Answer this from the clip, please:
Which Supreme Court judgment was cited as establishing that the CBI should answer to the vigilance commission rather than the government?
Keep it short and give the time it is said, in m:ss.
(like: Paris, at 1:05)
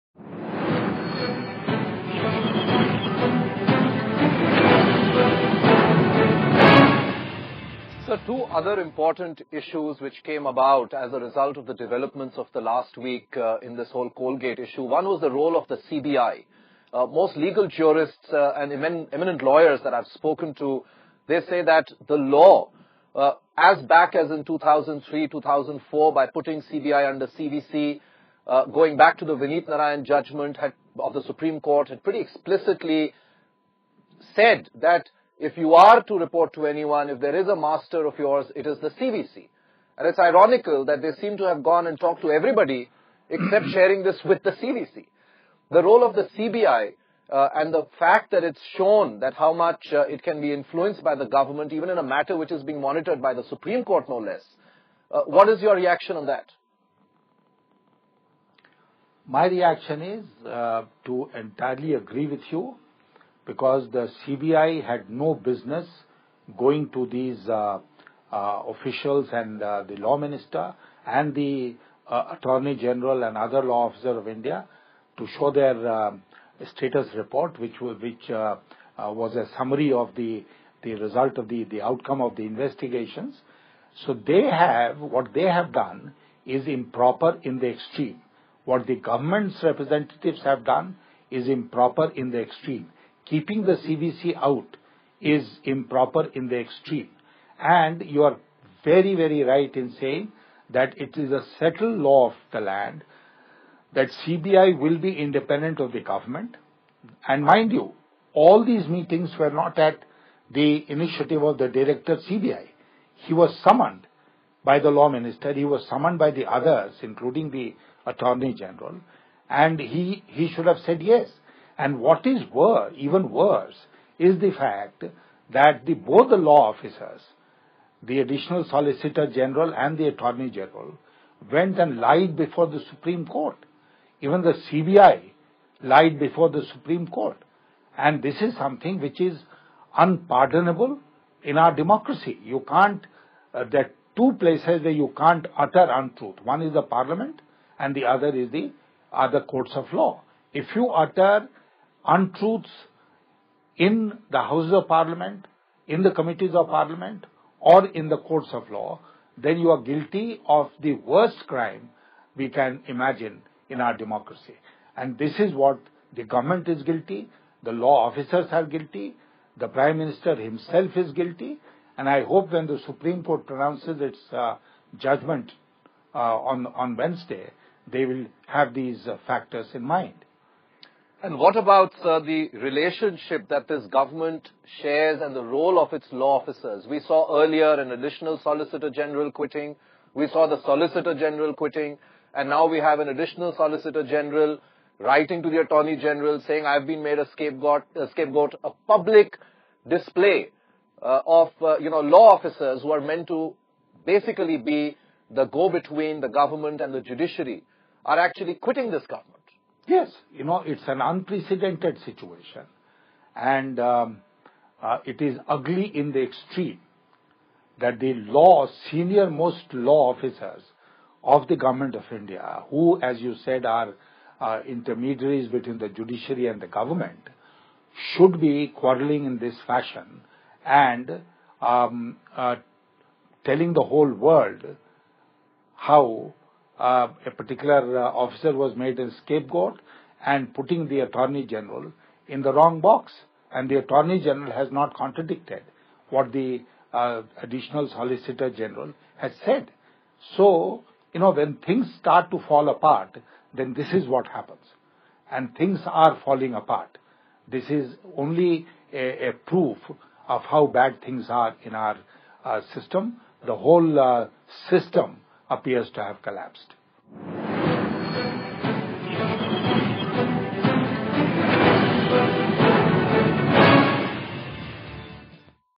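Vineet Narayan judgment, at 0:29.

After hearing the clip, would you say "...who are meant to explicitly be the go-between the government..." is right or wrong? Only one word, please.
wrong.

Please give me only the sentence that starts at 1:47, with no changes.
And mind you, all these meetings were not at the initiative of the director CBI.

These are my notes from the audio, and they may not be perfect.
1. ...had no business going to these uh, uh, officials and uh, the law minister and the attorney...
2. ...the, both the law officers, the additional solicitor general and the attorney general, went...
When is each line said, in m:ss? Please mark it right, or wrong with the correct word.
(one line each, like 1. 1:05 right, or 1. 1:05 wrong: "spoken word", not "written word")
1. 1:04 right
2. 2:05 right.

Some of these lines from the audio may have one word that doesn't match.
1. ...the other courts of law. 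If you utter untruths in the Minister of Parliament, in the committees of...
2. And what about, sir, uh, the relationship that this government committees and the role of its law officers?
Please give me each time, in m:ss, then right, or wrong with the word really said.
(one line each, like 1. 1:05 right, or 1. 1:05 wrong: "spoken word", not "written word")
1. 2:28 wrong: "Houses", not "Minister"
2. 3:01 wrong: "shares", not "committees".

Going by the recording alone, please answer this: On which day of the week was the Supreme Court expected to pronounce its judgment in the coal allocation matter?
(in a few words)
Wednesday.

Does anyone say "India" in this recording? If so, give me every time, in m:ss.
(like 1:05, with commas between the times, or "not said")
1:14, 3:42.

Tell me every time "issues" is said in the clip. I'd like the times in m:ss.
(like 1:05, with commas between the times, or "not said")
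0:09, 0:14.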